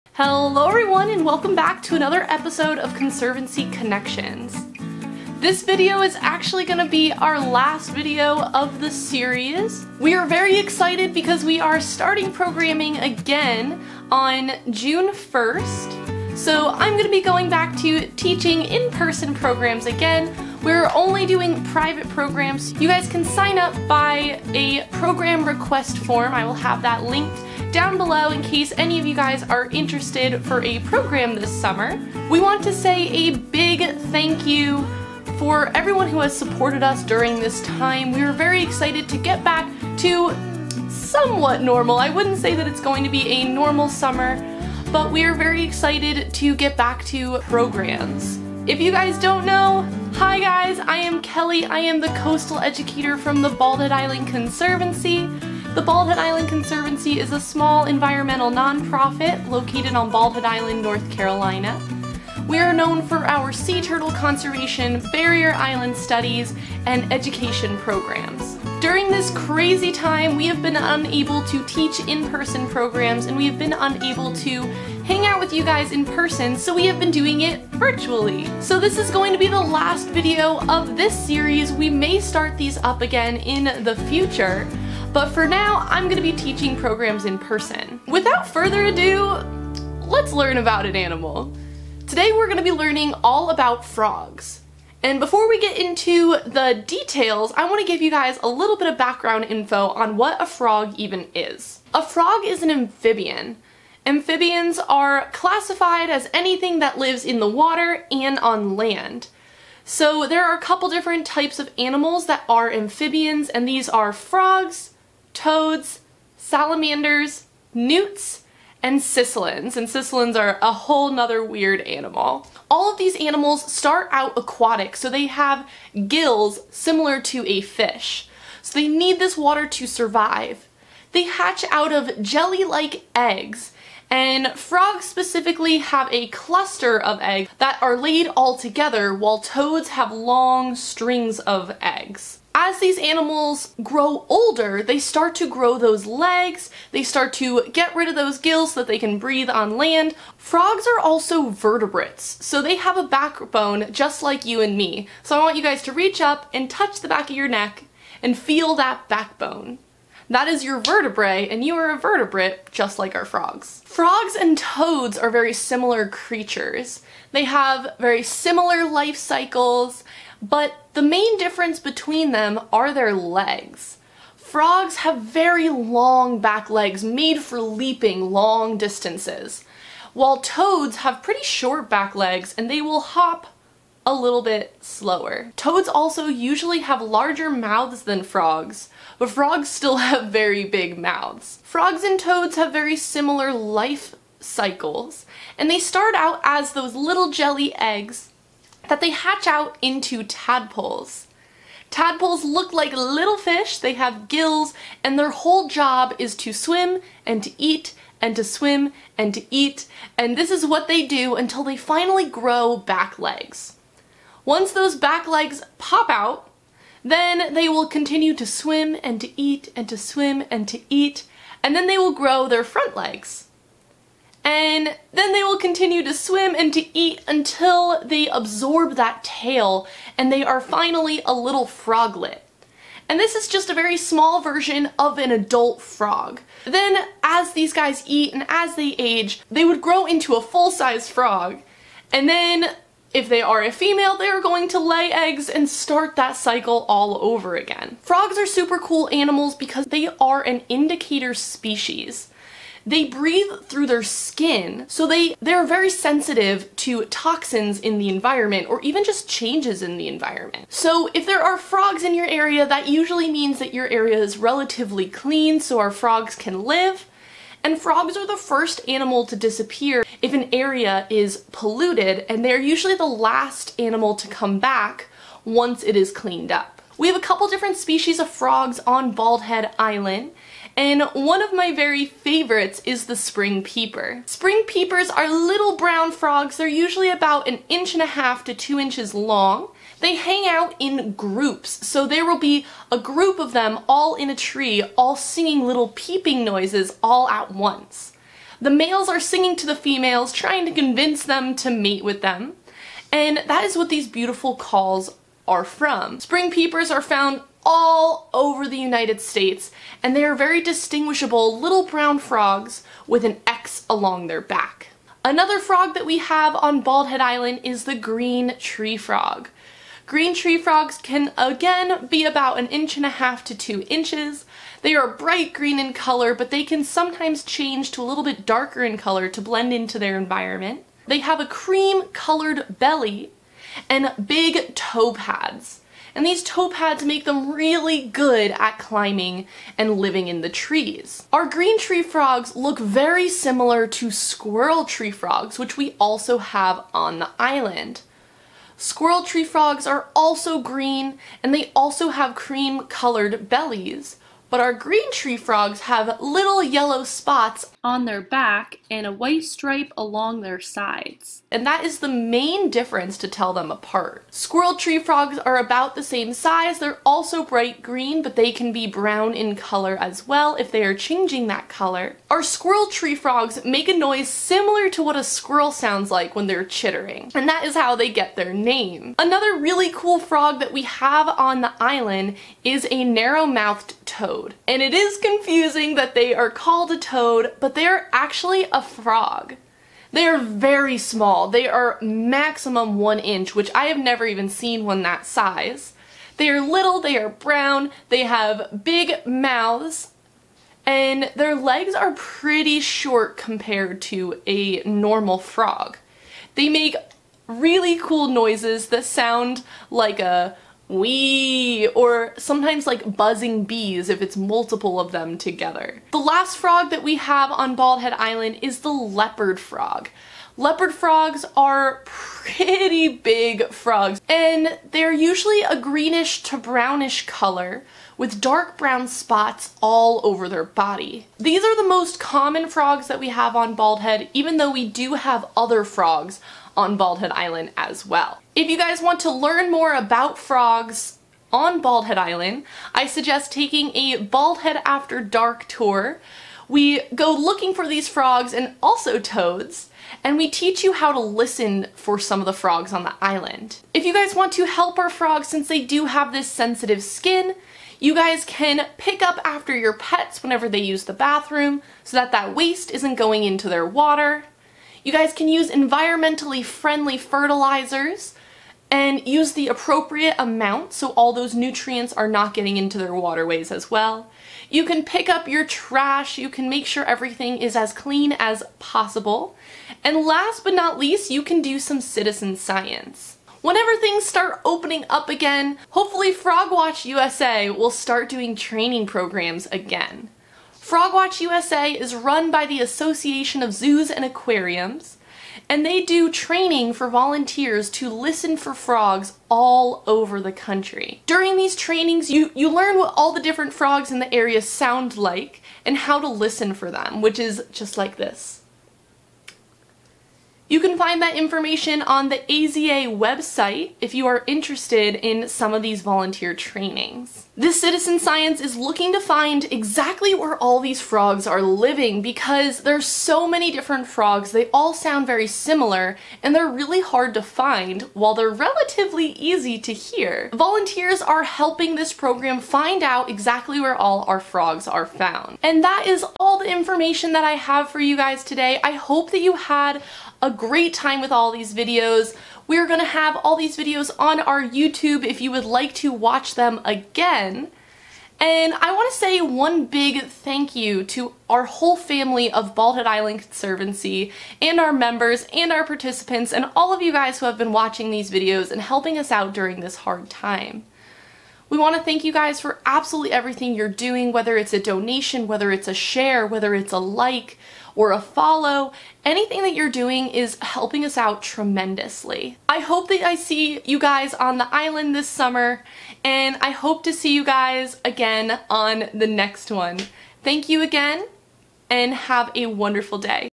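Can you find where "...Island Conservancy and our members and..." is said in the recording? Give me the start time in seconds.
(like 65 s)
553 s.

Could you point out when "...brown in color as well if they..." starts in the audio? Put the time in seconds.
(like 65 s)
368 s.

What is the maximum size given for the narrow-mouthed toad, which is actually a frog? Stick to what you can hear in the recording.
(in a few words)
1 inch.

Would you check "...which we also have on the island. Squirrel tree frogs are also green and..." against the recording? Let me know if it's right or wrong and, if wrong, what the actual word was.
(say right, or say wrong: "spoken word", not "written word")
right.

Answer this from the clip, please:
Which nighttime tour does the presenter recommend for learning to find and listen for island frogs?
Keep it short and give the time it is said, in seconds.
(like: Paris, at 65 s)
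Bald Head After Dark, at 444 s.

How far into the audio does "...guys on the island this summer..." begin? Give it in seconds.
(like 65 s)
573 s.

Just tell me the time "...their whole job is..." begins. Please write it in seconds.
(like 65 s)
205 s.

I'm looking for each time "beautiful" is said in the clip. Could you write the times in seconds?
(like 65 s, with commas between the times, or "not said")
304 s.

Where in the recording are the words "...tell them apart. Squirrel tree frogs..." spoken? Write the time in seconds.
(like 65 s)
363 s.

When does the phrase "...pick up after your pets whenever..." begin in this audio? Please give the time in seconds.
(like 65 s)
458 s.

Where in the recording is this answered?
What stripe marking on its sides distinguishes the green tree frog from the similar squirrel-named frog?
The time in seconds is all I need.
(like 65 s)
359 s.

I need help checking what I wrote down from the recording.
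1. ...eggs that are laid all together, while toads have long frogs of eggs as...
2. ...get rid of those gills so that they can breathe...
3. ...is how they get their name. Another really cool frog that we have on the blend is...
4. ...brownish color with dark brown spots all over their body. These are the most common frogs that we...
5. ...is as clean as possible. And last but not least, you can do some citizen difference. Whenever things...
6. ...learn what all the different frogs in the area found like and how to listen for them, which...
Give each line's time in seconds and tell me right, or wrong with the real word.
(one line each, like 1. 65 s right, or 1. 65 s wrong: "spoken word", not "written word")
1. 137 s wrong: "strings", not "frogs"
2. 147 s right
3. 377 s wrong: "island", not "blend"
4. 426 s right
5. 477 s wrong: "science", not "difference"
6. 502 s wrong: "sound", not "found".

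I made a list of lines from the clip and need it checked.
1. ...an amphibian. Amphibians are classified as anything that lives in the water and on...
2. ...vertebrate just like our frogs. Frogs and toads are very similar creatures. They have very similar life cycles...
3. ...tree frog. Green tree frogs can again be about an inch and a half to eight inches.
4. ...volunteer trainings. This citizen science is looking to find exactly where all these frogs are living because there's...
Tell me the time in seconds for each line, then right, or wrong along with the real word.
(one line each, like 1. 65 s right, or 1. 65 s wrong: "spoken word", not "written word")
1. 102 s right
2. 161 s right
3. 318 s wrong: "two", not "eight"
4. 516 s right.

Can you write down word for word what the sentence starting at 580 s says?
Thank you again and have a wonderful day.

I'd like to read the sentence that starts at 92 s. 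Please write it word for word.
Today we're gonna be learning all about frogs.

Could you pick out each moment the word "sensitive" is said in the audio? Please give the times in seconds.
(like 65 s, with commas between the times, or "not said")
255 s, 456 s.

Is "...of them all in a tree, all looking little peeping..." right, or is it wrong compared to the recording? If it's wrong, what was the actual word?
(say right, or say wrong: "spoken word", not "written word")
wrong: "singing", not "looking".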